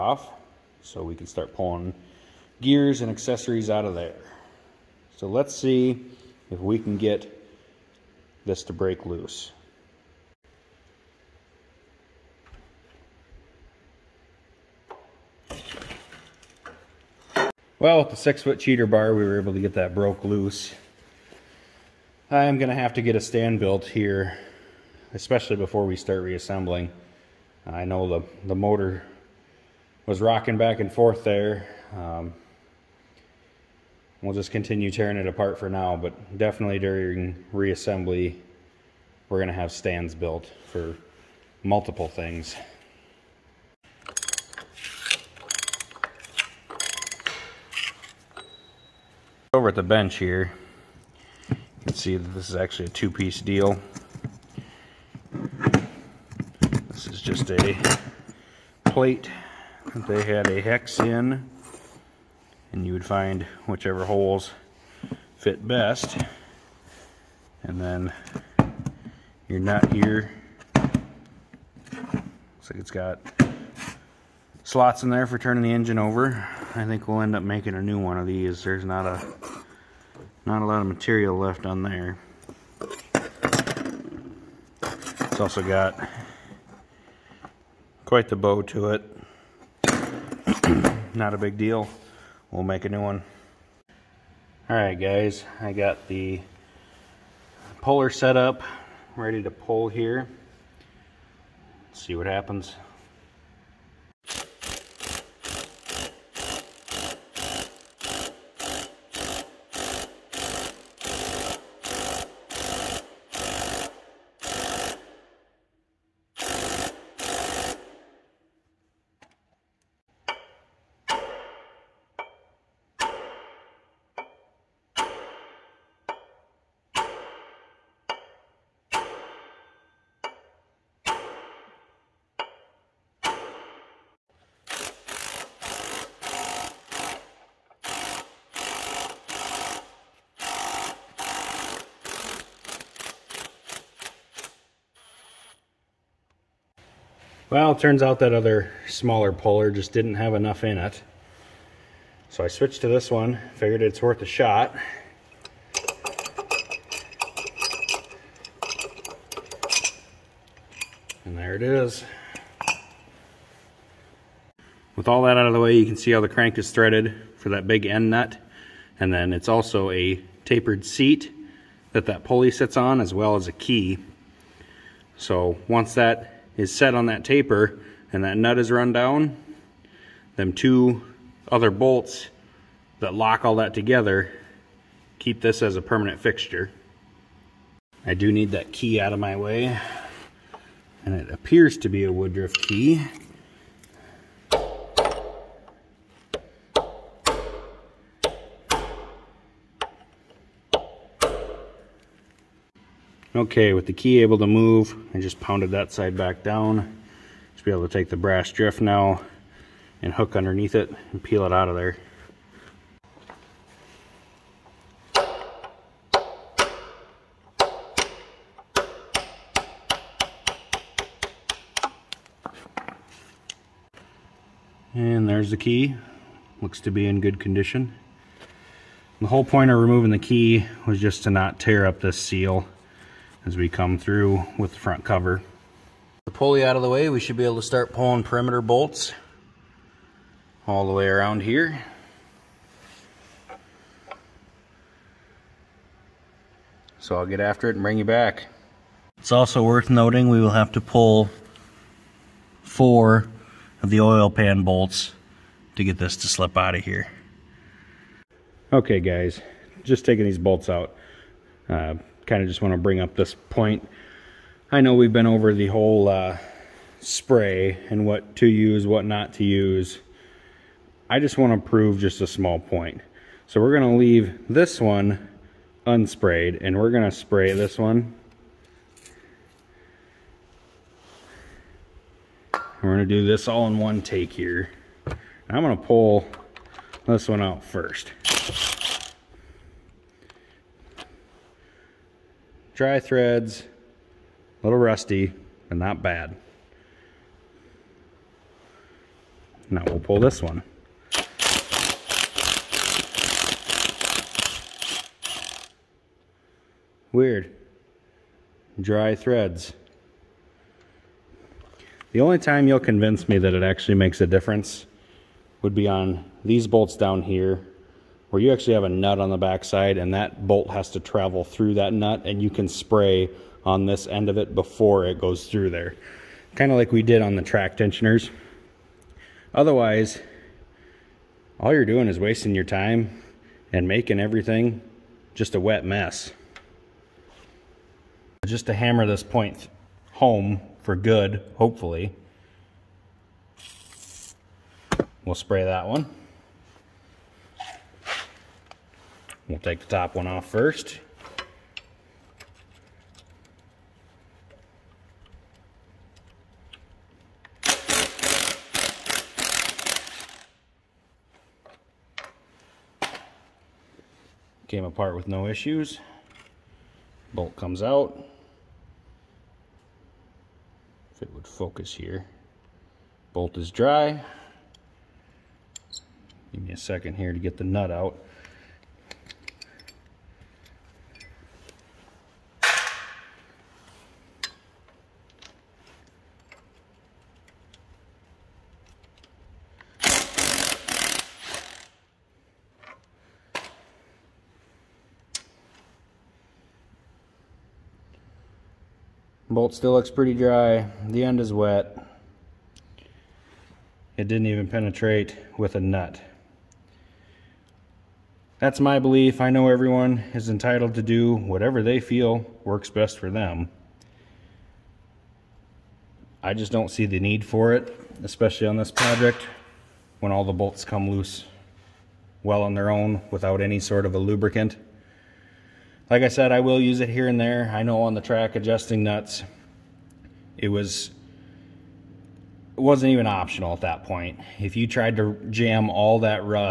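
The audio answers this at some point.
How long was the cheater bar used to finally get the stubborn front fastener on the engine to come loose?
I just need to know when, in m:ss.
0:18.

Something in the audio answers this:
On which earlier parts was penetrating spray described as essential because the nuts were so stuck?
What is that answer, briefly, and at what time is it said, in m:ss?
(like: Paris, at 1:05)
Track adjusting nuts, at 7:08.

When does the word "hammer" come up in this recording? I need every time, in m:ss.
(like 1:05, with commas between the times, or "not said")
5:38.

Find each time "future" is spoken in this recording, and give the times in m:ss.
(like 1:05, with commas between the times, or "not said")
not said.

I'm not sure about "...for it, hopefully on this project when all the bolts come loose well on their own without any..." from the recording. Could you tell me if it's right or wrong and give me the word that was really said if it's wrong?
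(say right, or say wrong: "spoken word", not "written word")
wrong: "especially", not "hopefully".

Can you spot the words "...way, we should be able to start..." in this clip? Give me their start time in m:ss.
3:56.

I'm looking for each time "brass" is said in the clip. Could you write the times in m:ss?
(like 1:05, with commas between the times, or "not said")
3:28.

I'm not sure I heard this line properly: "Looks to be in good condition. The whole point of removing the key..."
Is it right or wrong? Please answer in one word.
right.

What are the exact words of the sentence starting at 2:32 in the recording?
So I switched to this one, figured it's worth a shot.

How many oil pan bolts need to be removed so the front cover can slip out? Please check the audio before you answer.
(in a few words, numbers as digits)
4.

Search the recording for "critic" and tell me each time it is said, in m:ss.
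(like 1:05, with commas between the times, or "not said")
not said.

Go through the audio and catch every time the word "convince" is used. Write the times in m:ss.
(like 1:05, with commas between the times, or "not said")
5:12.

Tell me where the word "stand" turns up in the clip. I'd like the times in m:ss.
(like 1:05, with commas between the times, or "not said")
0:23, 0:39.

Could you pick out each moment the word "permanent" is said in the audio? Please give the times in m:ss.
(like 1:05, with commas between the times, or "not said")
3:05.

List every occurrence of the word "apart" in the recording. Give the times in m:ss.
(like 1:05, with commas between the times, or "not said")
0:35, 6:04.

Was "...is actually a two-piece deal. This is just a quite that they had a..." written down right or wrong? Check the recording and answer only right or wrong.
wrong.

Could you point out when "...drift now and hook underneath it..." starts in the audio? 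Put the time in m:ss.
3:28.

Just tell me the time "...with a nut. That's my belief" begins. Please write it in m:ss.
6:45.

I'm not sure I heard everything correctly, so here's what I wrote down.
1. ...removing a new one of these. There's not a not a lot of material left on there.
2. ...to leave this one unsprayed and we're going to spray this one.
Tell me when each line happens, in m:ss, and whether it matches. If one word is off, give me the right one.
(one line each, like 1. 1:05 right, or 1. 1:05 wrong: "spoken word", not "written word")
1. 1:17 wrong: "making", not "removing"
2. 4:33 right.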